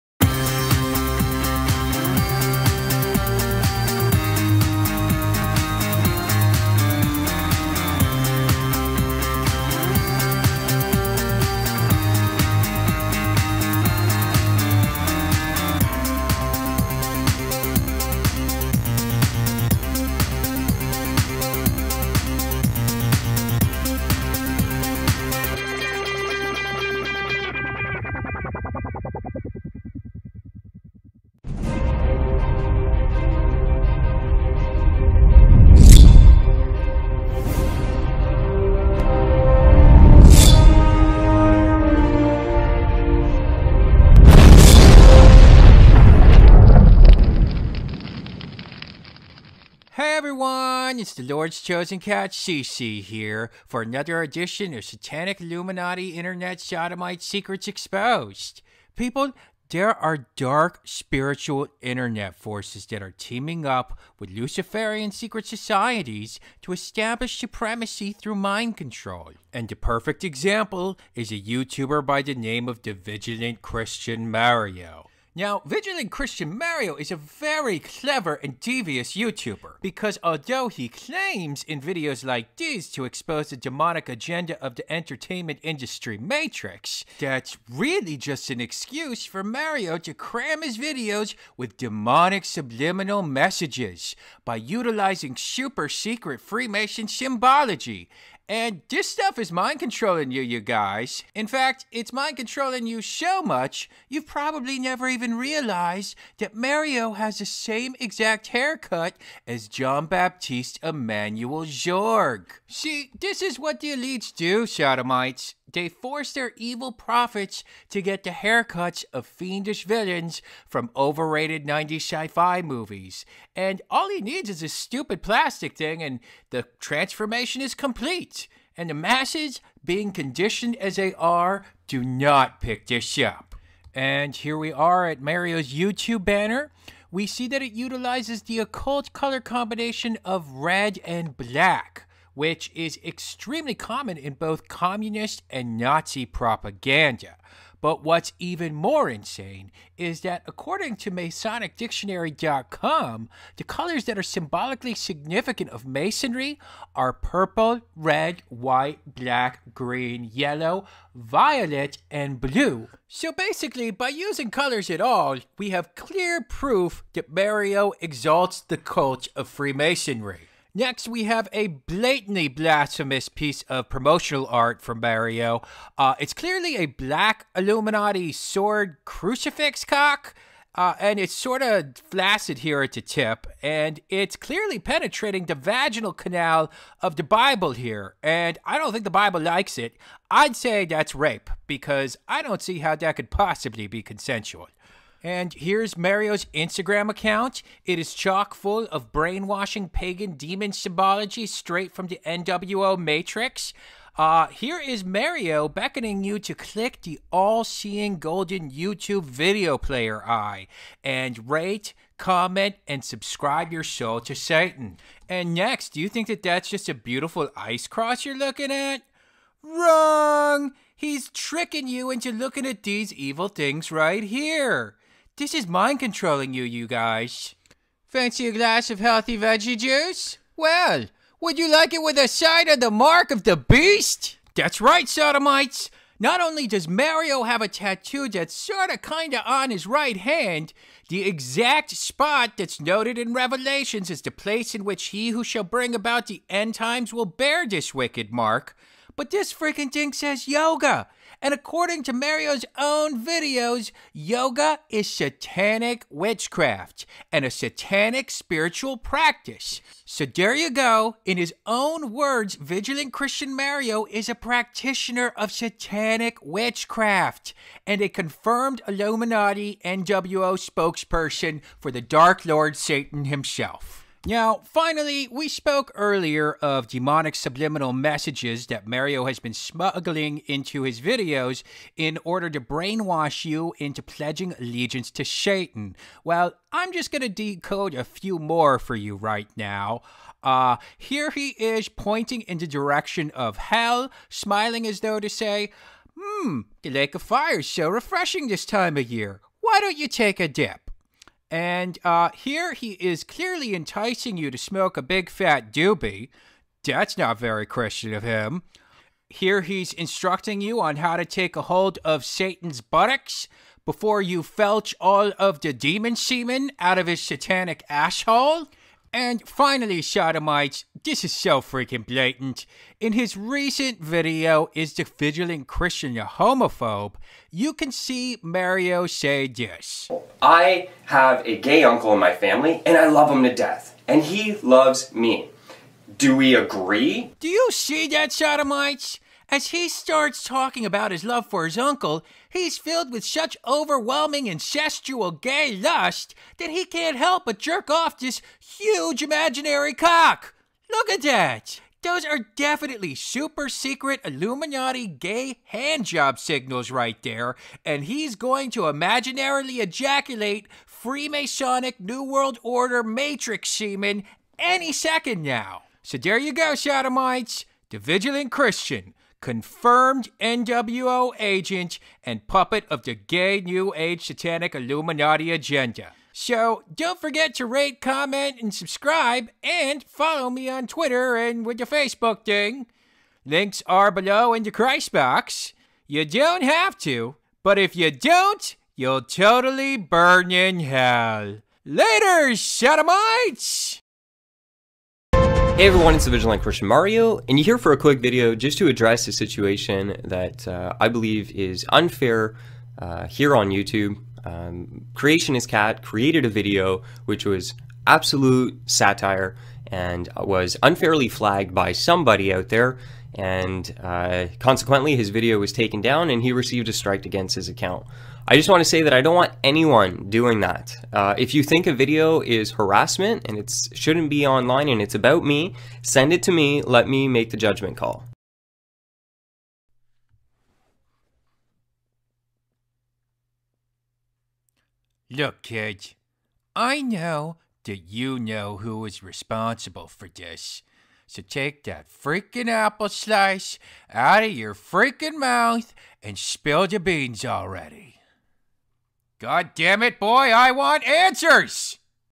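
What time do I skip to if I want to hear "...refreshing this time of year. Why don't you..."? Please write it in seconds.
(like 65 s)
297 s.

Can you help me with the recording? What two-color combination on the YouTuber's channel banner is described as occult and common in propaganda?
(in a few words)
red and black.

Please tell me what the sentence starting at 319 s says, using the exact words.
And finally, Sodomites, this is so freaking blatant.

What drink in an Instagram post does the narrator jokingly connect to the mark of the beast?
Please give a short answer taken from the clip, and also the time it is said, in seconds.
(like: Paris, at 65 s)
veggie juice, at 229 s.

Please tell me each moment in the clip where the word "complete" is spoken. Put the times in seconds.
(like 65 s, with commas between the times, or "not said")
127 s.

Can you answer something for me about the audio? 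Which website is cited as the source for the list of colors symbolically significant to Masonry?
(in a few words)
MasonicDictionary.com.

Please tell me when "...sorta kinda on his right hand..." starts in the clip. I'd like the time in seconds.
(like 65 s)
238 s.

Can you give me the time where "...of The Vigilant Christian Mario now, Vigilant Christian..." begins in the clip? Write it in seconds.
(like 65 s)
72 s.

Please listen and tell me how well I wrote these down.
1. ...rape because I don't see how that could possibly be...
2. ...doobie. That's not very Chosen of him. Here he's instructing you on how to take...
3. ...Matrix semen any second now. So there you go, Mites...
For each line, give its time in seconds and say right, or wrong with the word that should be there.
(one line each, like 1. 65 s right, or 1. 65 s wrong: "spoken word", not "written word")
1. 191 s right
2. 305 s wrong: "Christian", not "Chosen"
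3. 363 s right.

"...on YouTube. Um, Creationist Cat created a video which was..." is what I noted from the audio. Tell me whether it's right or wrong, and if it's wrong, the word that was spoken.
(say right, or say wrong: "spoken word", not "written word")
right.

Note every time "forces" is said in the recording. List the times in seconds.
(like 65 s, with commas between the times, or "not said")
62 s, 115 s.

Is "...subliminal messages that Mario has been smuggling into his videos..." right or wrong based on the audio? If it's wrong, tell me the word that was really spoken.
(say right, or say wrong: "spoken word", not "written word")
right.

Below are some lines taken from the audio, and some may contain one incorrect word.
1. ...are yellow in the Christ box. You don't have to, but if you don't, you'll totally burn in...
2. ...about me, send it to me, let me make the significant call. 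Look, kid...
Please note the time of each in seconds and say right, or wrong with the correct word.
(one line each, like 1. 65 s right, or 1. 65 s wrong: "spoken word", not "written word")
1. 383 s wrong: "below", not "yellow"
2. 425 s wrong: "judgment", not "significant".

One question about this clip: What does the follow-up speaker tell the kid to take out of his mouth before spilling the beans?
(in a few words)
apple slice.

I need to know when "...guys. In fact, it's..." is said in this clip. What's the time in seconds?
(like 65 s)
100 s.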